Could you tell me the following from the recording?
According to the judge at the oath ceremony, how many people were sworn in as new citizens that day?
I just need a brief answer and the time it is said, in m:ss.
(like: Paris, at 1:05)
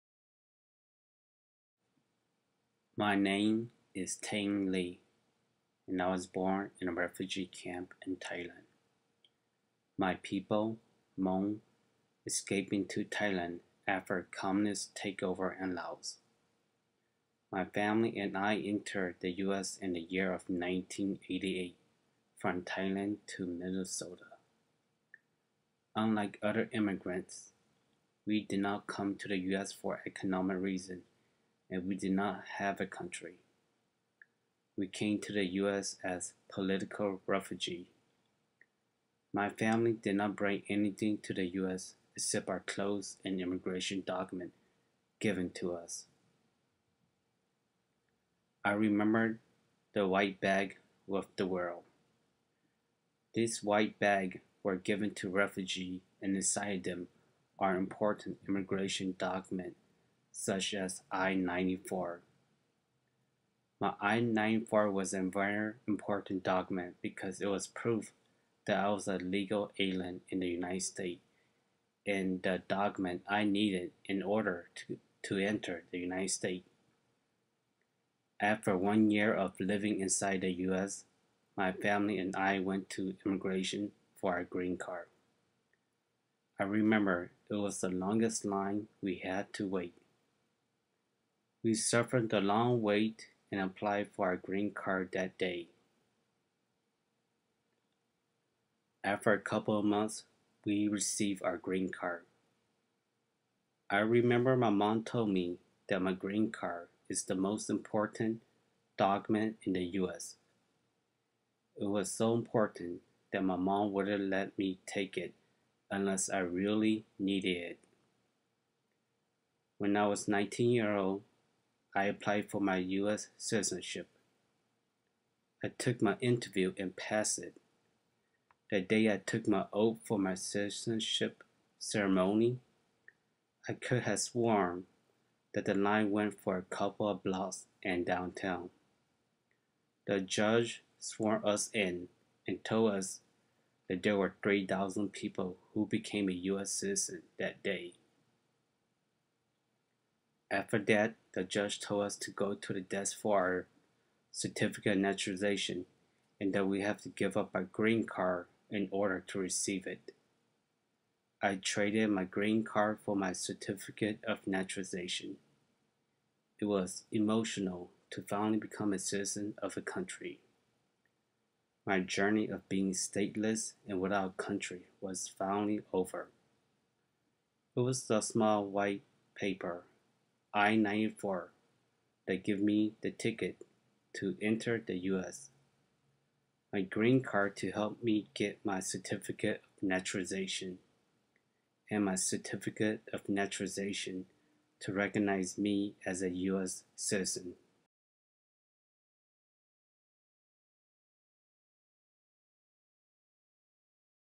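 3,000, at 2:24.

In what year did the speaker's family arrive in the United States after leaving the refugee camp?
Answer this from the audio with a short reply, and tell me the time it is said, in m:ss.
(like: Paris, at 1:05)
1988, at 0:20.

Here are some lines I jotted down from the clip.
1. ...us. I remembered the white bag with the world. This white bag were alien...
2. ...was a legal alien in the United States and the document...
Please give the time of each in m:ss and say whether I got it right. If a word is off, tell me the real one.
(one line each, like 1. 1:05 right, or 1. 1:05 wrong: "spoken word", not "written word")
1. 0:45 wrong: "given", not "alien"
2. 1:08 right.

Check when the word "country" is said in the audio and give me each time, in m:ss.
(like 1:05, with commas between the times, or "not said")
0:32, 2:49, 2:54.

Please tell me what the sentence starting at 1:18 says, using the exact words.
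After one year of living inside the US, my family and I went to immigration for our green card.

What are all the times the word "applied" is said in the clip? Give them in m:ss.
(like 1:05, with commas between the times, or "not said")
1:33, 2:02.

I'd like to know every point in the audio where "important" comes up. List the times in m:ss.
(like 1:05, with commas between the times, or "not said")
0:57, 1:05, 1:47, 1:52.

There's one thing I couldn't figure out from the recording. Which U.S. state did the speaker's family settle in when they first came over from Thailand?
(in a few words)
Minnesota.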